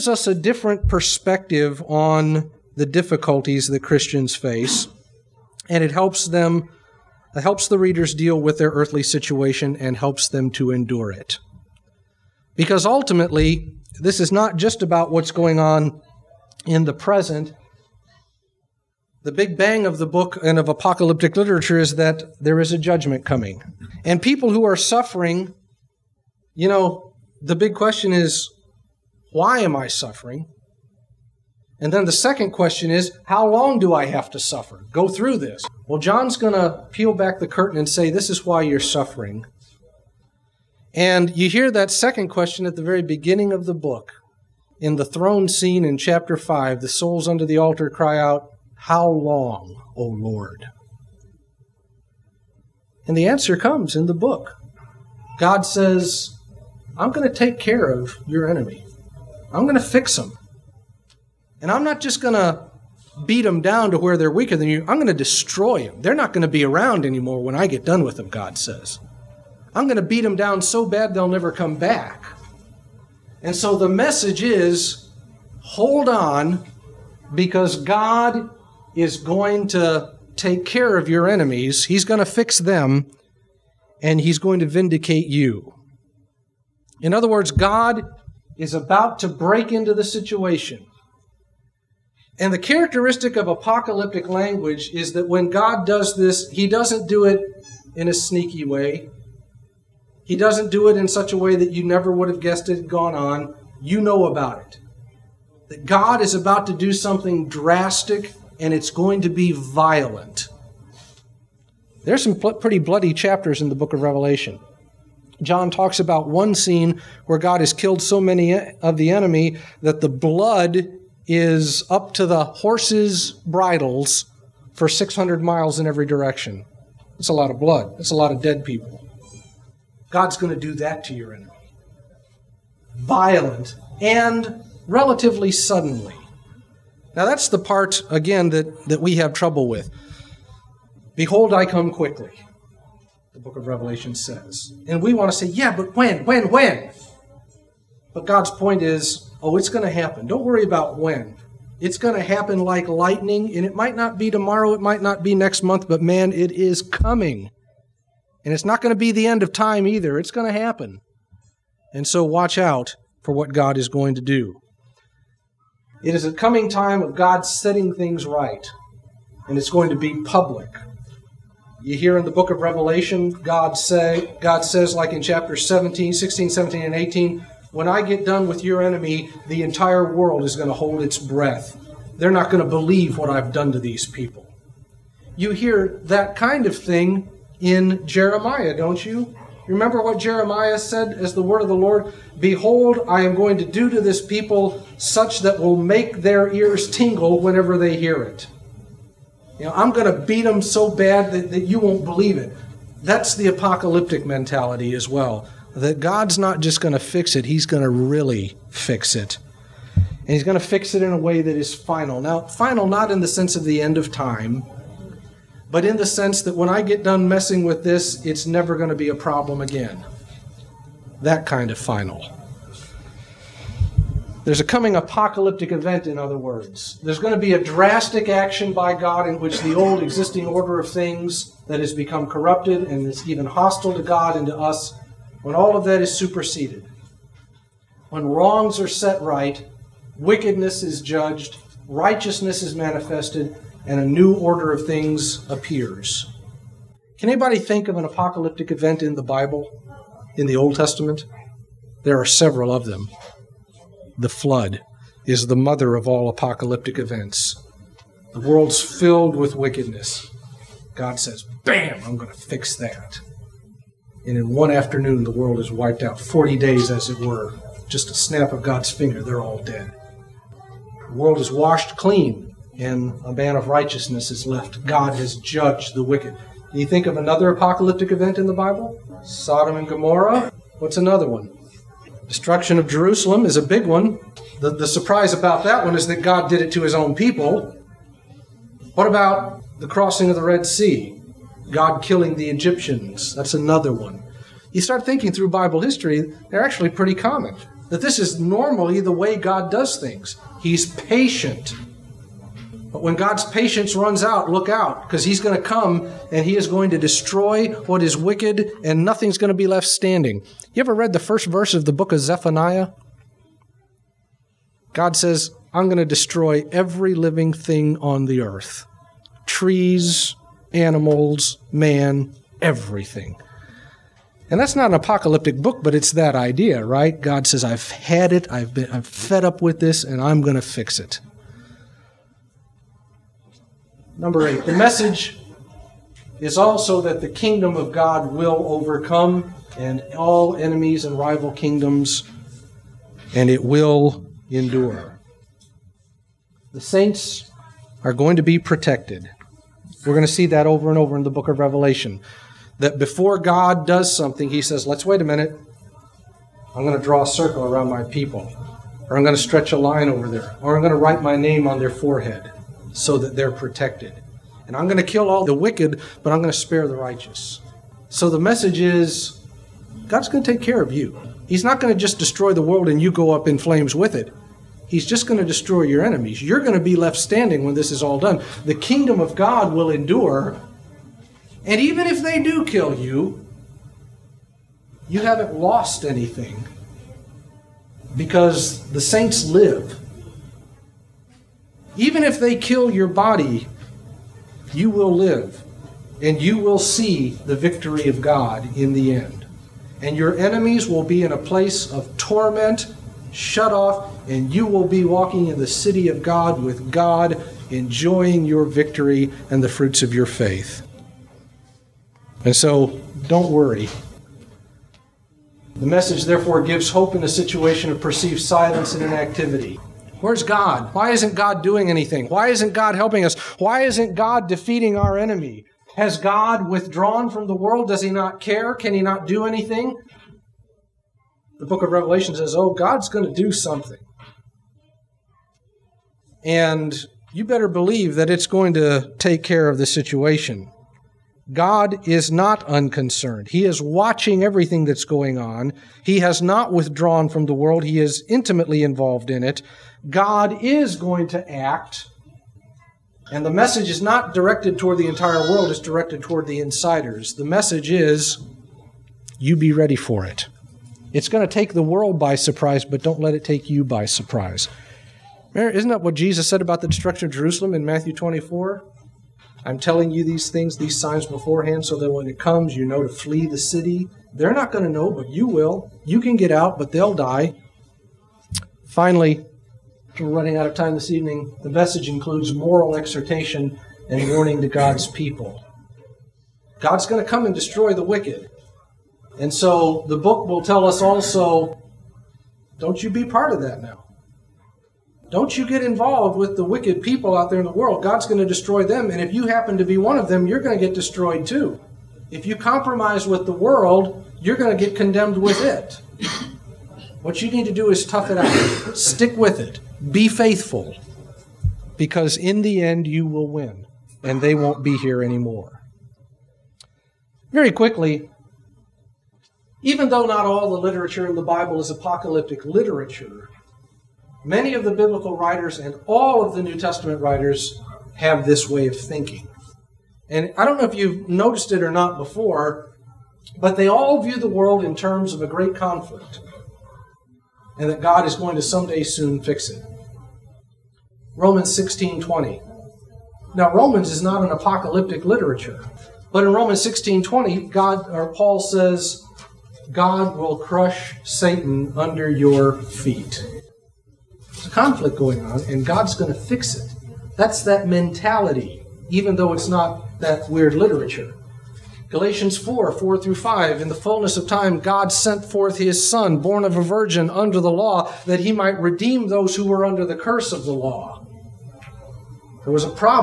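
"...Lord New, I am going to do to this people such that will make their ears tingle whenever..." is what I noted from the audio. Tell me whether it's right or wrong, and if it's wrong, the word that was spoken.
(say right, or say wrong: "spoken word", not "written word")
wrong: "Behold", not "New".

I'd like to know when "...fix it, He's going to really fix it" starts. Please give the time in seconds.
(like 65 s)
206 s.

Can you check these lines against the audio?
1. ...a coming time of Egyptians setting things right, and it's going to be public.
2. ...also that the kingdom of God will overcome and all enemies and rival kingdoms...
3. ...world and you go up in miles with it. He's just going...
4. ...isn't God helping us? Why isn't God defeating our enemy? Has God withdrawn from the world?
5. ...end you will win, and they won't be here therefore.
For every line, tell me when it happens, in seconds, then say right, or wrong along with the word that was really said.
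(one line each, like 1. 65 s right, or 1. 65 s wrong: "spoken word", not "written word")
1. 166 s wrong: "God", not "Egyptians"
2. 336 s right
3. 372 s wrong: "flames", not "miles"
4. 422 s right
5. 512 s wrong: "anymore", not "therefore".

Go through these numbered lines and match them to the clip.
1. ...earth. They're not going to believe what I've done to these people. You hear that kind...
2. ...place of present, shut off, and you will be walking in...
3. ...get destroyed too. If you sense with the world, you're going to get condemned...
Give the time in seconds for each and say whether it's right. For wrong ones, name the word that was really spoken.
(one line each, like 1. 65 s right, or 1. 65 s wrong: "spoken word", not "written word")
1. 181 s wrong: "breath", not "earth"
2. 401 s wrong: "torment", not "present"
3. 500 s wrong: "compromise", not "sense".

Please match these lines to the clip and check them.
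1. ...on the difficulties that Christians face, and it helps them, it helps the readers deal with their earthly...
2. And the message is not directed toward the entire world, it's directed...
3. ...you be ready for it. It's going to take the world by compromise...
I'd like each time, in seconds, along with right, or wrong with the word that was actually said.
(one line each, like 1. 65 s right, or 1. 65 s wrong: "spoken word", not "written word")
1. 1 s right
2. 453 s right
3. 459 s wrong: "surprise", not "compromise".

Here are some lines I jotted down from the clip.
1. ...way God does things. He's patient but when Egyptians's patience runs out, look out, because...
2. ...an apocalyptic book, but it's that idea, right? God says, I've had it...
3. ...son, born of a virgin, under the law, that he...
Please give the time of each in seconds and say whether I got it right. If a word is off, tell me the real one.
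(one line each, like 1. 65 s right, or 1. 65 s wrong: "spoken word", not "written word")
1. 299 s wrong: "God", not "Egyptians"
2. 324 s right
3. 566 s right.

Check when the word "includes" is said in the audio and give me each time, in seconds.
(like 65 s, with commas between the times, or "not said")
482 s.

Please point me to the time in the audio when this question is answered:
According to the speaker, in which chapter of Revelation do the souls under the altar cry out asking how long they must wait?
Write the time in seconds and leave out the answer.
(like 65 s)
45 s.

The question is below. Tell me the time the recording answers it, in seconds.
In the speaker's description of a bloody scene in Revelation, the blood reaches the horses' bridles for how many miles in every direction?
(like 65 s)
124 s.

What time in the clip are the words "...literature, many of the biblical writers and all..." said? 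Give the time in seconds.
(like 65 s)
522 s.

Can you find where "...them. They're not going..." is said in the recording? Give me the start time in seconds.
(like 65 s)
65 s.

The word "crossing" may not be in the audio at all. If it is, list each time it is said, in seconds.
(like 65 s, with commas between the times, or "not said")
289 s.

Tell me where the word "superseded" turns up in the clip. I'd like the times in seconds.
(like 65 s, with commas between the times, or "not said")
236 s.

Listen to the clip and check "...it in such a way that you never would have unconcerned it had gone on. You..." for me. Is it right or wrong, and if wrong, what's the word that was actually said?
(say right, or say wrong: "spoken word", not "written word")
wrong: "guessed", not "unconcerned".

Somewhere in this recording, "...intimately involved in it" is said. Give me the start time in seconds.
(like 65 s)
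448 s.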